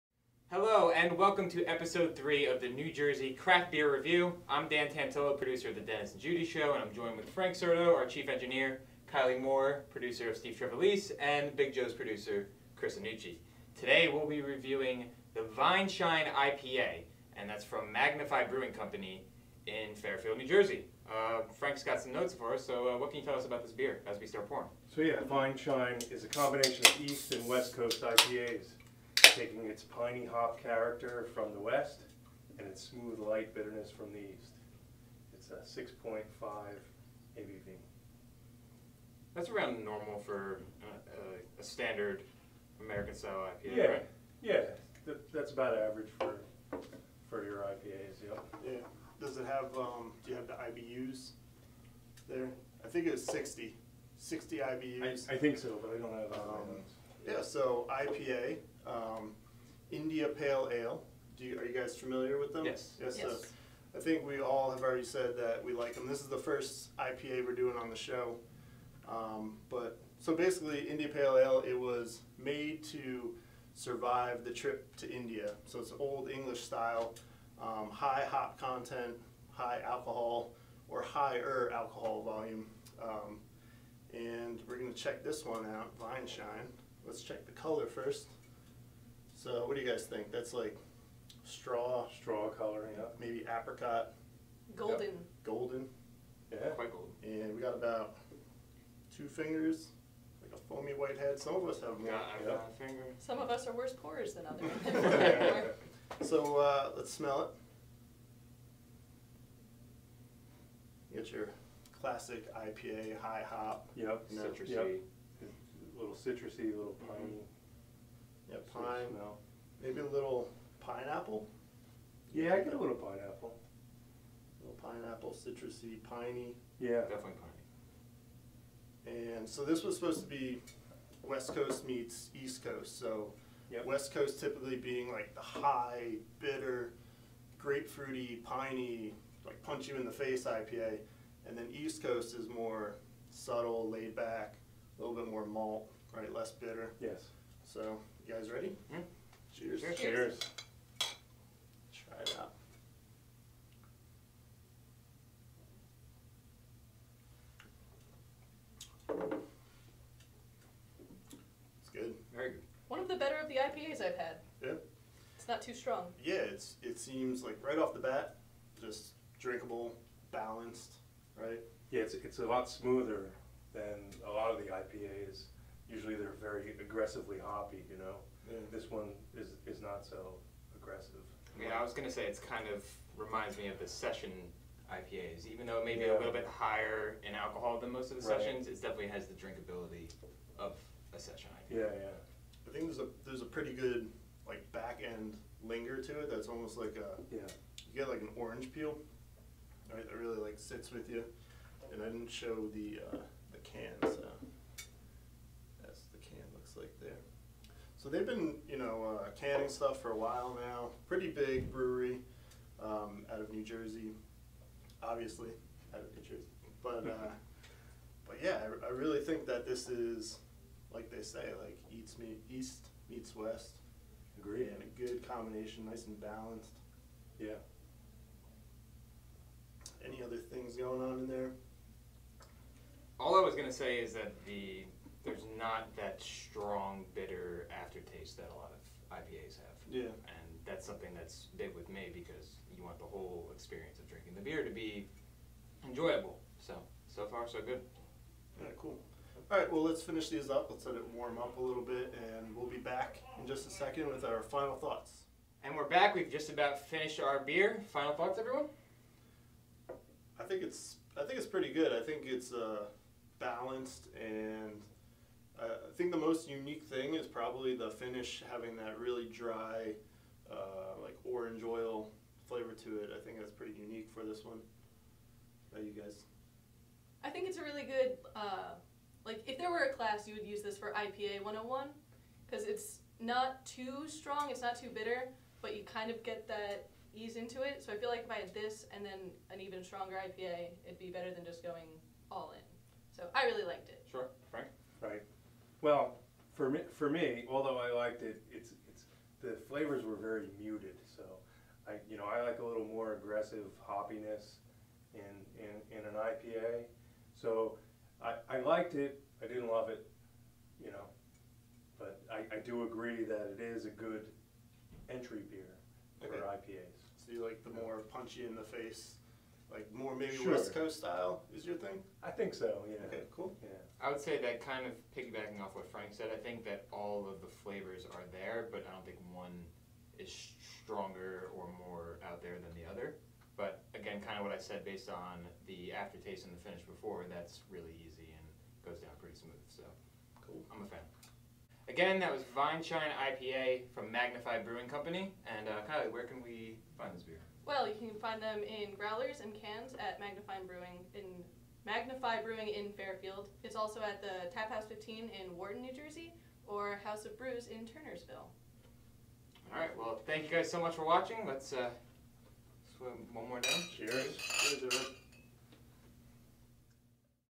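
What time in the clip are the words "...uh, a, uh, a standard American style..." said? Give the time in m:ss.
0:40.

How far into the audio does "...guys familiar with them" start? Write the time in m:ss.
1:01.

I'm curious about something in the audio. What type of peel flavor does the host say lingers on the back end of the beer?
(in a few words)
orange peel.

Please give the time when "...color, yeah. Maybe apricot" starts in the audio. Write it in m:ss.
1:32.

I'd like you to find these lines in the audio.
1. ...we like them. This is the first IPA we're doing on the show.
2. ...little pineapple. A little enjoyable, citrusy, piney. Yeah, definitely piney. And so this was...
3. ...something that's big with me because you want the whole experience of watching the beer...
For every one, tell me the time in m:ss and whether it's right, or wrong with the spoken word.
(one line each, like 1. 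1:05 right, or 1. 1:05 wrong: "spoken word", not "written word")
1. 1:05 right
2. 2:02 wrong: "pineapple", not "enjoyable"
3. 4:00 wrong: "drinking", not "watching".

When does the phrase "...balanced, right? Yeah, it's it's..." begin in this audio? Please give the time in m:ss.
2:50.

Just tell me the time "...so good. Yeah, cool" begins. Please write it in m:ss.
4:07.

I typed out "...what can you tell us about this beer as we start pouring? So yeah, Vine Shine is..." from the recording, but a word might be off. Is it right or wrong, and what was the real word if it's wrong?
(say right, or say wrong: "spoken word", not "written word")
right.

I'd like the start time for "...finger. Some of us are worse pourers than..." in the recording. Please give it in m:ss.
1:42.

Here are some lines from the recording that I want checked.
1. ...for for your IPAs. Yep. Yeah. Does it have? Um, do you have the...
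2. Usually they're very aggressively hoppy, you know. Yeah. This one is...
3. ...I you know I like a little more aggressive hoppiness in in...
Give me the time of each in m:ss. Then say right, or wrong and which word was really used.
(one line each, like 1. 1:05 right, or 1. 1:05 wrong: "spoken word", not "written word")
1. 0:46 right
2. 2:55 right
3. 5:01 right.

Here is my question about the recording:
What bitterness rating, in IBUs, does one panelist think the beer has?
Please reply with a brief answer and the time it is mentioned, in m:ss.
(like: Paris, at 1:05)
60, at 0:54.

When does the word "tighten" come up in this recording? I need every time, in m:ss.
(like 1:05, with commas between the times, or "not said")
not said.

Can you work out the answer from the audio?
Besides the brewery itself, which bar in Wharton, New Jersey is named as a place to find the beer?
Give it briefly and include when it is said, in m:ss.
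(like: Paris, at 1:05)
Tap House 15, at 5:54.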